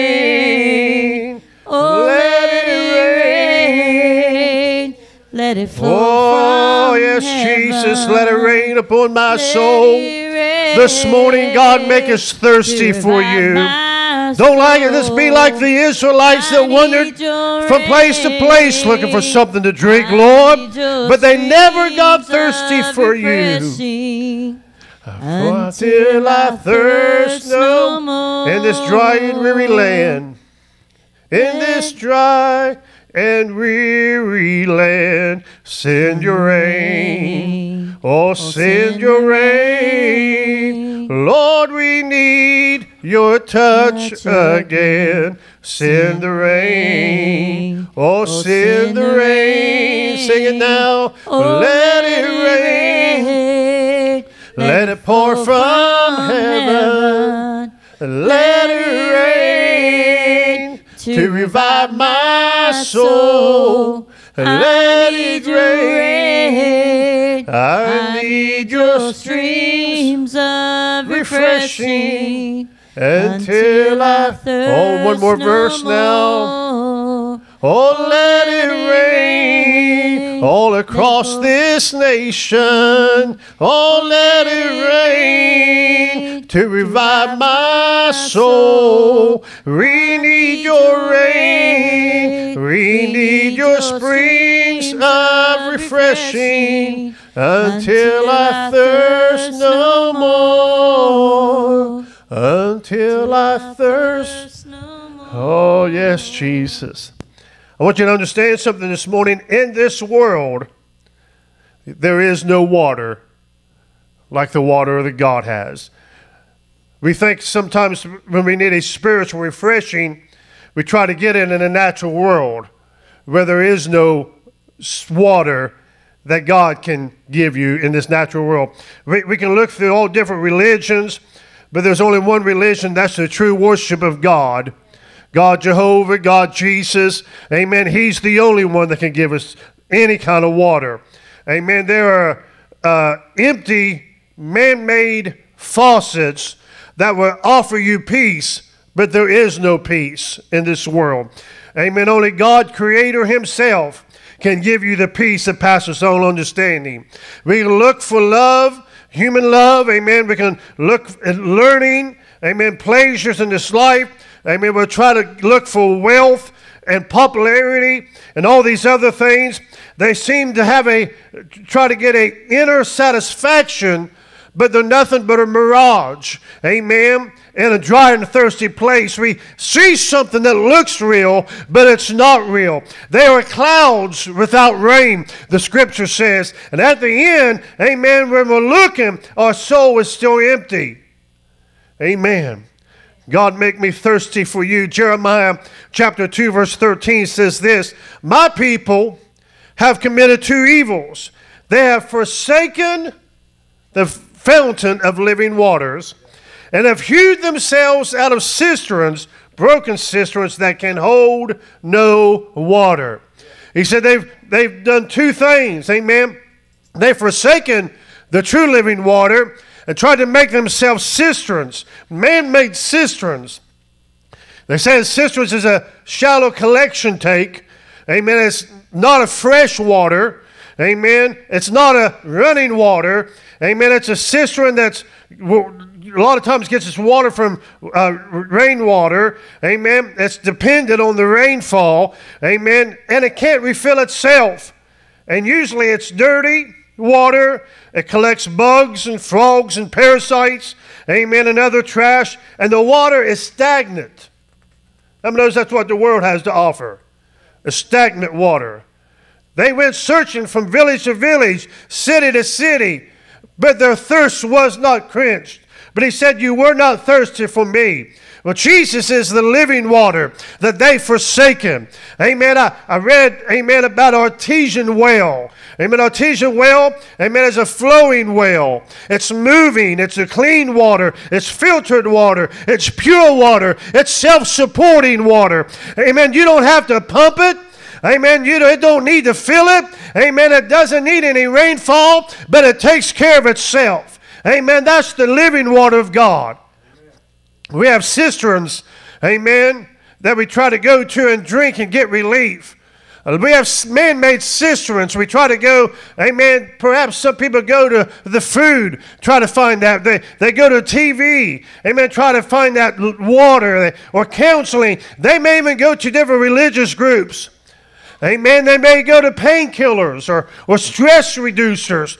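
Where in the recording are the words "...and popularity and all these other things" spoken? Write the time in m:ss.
2:46.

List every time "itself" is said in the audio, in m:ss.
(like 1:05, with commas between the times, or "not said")
4:03, 4:53.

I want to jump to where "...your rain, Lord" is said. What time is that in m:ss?
0:39.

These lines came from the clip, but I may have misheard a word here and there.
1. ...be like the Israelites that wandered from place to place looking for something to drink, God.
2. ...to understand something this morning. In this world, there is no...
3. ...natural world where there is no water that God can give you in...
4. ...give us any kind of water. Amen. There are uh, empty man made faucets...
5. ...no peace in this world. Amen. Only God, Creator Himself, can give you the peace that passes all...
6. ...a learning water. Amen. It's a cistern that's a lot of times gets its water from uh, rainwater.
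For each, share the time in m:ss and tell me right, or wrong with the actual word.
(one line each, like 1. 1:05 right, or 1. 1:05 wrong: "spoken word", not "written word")
1. 0:15 wrong: "Lord", not "God"
2. 1:48 right
3. 2:01 right
4. 2:19 right
5. 2:29 right
6. 3:51 wrong: "running", not "learning".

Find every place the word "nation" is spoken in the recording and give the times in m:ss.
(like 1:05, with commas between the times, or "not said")
1:21.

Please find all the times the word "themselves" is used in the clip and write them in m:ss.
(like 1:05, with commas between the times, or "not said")
3:27, 3:40.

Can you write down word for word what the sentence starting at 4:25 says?
But he said, You were not thirsty for me.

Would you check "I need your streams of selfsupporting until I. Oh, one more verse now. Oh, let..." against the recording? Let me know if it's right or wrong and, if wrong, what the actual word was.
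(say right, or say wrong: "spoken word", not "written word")
wrong: "refreshing", not "selfsupporting".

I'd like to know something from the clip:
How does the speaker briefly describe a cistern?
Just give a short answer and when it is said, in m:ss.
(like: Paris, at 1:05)
A shallow collection tank, at 3:46.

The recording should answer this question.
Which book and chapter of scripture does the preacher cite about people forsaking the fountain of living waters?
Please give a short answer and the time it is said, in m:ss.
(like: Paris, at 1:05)
Jeremiah chapter 2, at 3:14.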